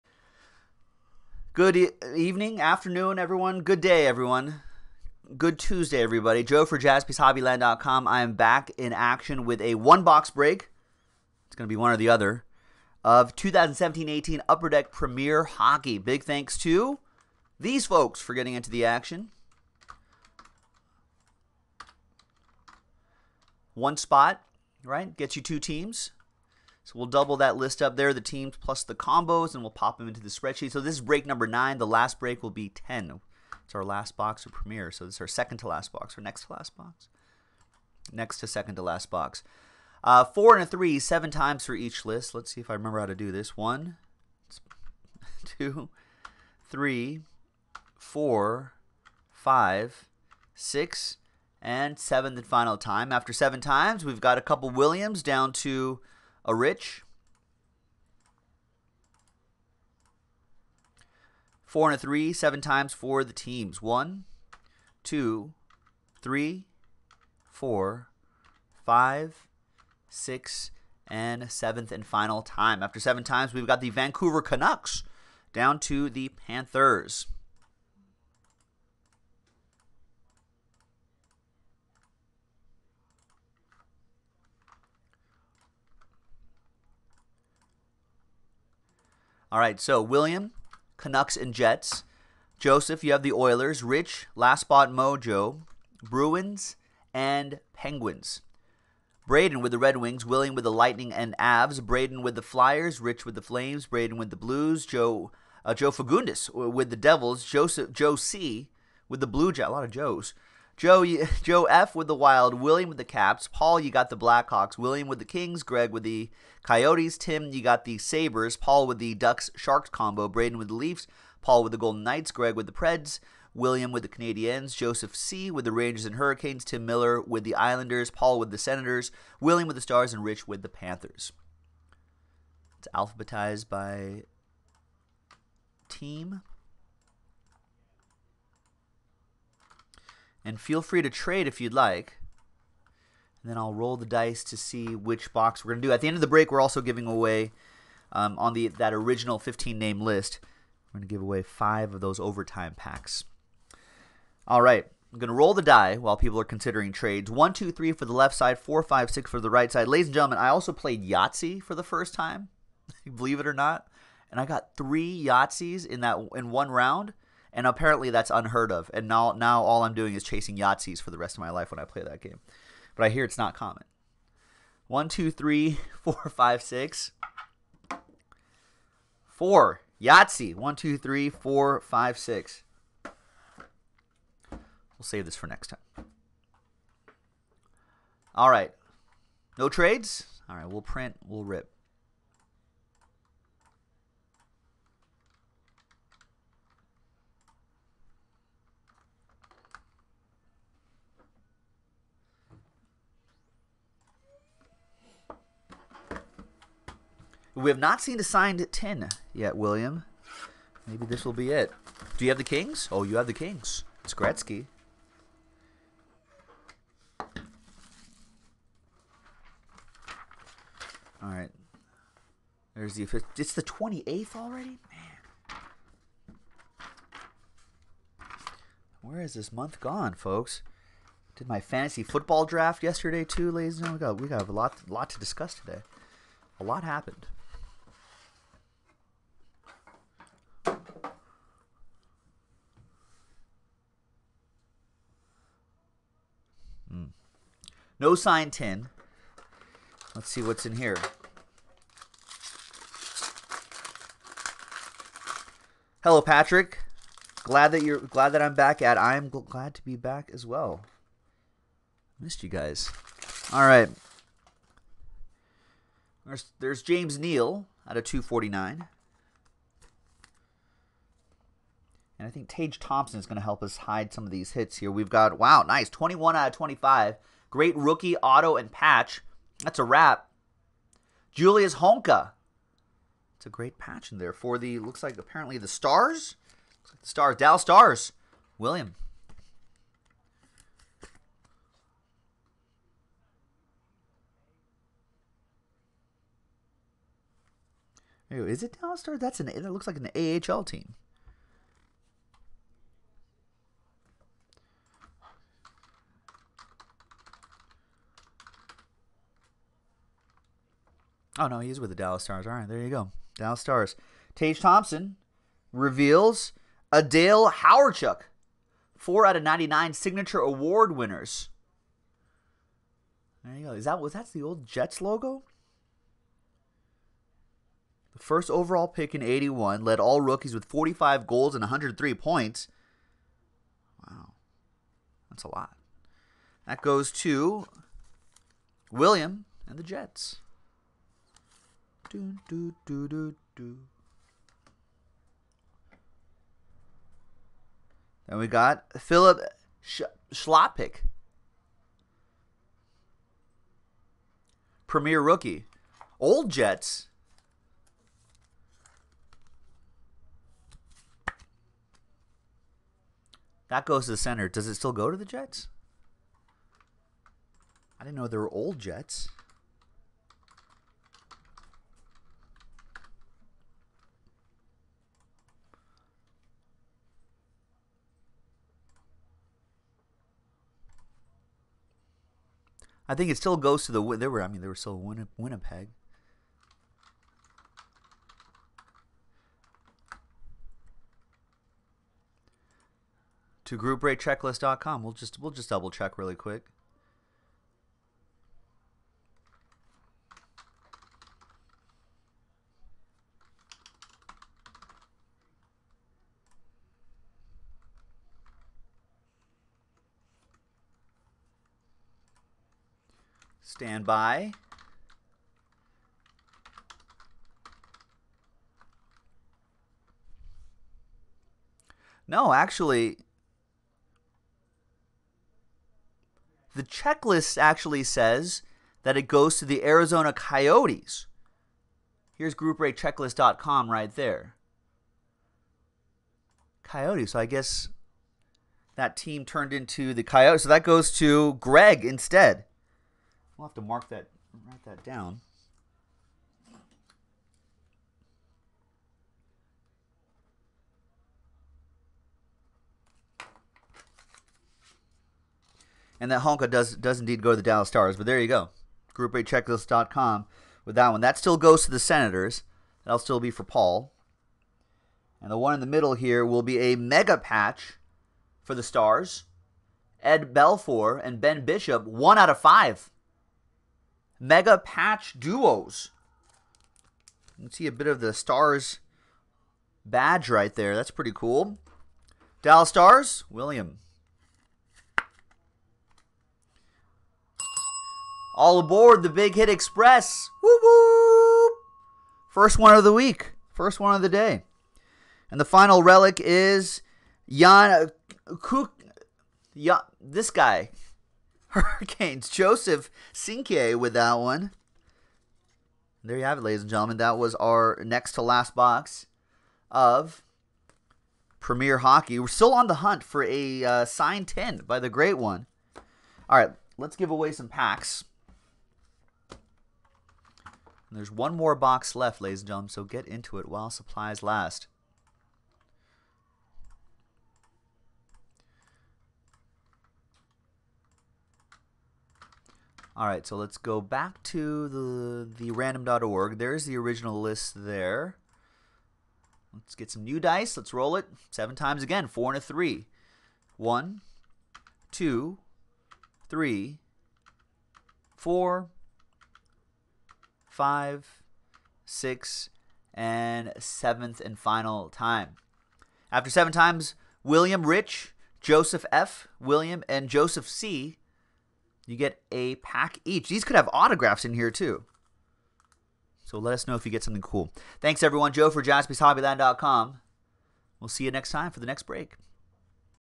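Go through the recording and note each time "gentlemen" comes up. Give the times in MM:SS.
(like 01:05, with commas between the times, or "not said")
02:40, 03:53, 08:26, 08:42.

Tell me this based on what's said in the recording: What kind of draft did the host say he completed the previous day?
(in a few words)
fantasy football draft.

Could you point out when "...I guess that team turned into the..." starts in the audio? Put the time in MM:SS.
07:17.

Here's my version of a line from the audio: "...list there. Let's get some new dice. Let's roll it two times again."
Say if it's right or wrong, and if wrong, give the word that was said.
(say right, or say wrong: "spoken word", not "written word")
wrong: "seven", not "two".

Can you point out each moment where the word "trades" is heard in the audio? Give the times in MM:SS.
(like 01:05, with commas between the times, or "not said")
02:21, 02:36, 03:09.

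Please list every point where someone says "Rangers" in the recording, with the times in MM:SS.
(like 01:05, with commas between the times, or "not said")
02:05.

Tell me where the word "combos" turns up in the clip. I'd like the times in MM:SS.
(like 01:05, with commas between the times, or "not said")
00:28, 01:59.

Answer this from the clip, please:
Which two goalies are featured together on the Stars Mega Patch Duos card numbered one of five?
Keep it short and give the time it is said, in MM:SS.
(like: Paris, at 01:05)
Ed Belfour and Ben Bishop, at 07:50.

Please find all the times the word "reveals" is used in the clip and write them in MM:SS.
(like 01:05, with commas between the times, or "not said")
05:15.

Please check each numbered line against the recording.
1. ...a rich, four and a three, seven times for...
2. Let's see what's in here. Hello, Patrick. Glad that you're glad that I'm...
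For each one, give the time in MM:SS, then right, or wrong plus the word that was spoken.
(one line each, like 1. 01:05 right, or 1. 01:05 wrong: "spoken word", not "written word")
1. 00:56 right
2. 04:10 right.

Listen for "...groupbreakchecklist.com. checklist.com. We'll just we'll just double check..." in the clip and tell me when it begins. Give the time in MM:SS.
06:33.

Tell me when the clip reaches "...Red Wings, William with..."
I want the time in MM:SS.
01:39.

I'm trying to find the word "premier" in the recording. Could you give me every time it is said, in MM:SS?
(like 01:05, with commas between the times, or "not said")
00:14, 00:34, 05:54, 08:31.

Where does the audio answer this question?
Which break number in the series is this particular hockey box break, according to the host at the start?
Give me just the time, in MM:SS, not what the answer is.
00:31.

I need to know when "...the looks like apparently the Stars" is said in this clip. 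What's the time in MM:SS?
04:44.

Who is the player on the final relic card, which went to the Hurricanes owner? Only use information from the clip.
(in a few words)
Jan Kuk.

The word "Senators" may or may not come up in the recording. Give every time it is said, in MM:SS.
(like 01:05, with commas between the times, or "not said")
02:08, 07:41.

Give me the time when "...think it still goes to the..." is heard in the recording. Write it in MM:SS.
06:23.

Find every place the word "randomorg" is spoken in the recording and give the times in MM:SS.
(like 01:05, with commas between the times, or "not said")
08:55.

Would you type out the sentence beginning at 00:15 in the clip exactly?
Big thanks to these folks for getting into the action.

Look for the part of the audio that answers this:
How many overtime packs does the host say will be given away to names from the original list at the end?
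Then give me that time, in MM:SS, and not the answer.
02:31.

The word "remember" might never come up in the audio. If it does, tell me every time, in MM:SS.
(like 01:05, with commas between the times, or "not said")
00:42.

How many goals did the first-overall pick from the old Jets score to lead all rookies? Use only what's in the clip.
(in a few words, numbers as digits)
45.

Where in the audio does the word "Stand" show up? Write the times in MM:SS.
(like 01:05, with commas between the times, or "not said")
06:53.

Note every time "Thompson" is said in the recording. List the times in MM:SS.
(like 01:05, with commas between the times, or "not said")
04:32, 05:14.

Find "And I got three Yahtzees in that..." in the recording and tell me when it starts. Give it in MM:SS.
02:44.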